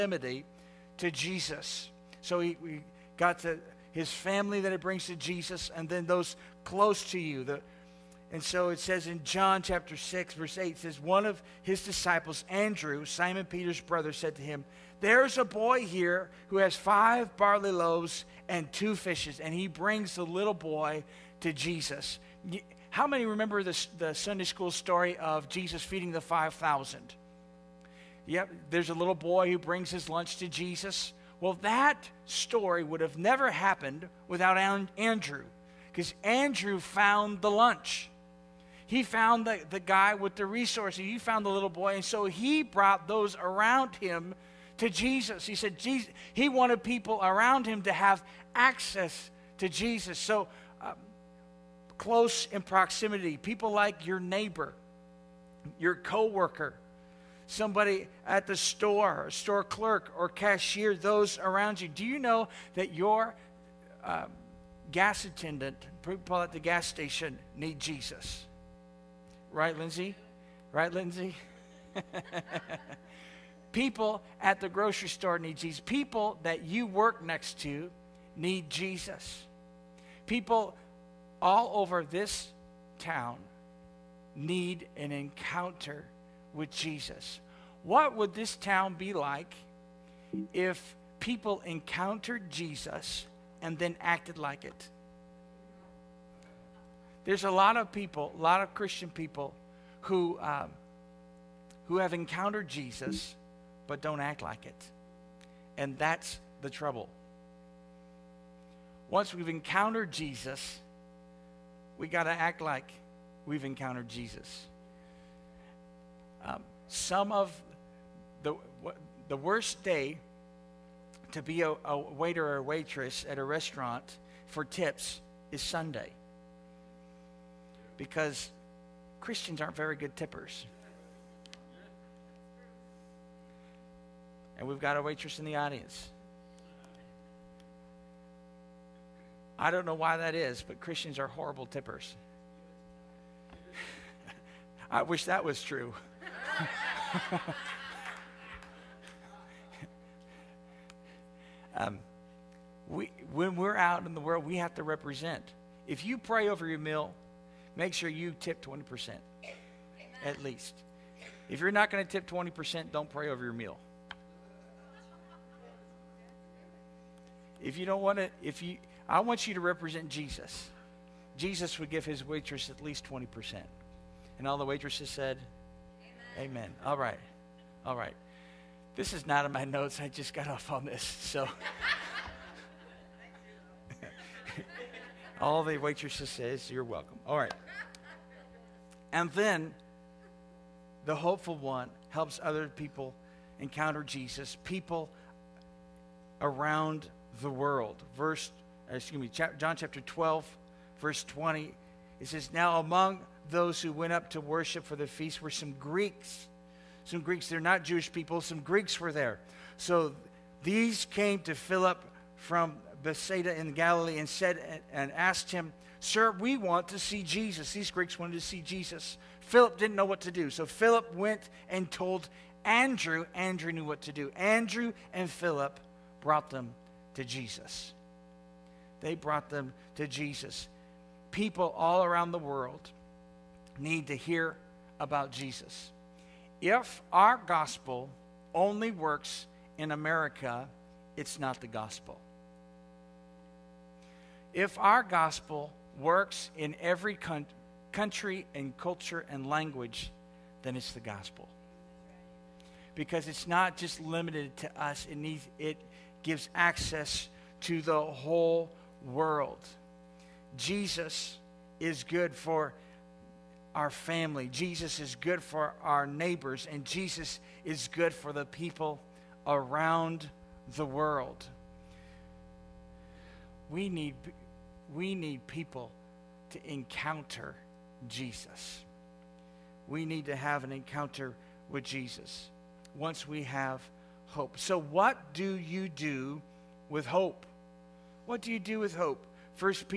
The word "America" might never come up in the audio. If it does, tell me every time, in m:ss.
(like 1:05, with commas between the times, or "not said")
3:59.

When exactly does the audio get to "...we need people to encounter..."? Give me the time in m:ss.
4:34.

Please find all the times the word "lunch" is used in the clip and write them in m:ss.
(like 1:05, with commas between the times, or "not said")
0:30, 0:37.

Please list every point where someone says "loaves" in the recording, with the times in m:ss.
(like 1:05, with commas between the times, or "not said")
0:17.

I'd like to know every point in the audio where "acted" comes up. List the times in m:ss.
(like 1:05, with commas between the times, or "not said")
1:33.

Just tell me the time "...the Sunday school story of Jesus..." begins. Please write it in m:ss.
0:23.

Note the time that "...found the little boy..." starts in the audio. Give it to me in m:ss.
0:41.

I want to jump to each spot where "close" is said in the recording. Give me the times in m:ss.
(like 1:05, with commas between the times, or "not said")
0:06, 0:52.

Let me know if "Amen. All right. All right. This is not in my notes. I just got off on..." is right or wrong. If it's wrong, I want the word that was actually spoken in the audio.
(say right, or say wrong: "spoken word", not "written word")
right.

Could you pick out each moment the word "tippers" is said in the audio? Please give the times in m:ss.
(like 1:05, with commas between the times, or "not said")
2:10, 2:21.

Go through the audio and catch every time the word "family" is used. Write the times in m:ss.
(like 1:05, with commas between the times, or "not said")
0:04, 4:23.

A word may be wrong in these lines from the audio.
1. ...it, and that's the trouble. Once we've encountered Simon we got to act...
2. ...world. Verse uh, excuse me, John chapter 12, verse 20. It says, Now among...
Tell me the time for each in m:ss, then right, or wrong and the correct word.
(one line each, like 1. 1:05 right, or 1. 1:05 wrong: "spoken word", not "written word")
1. 1:44 wrong: "Jesus", not "Simon"
2. 3:17 right.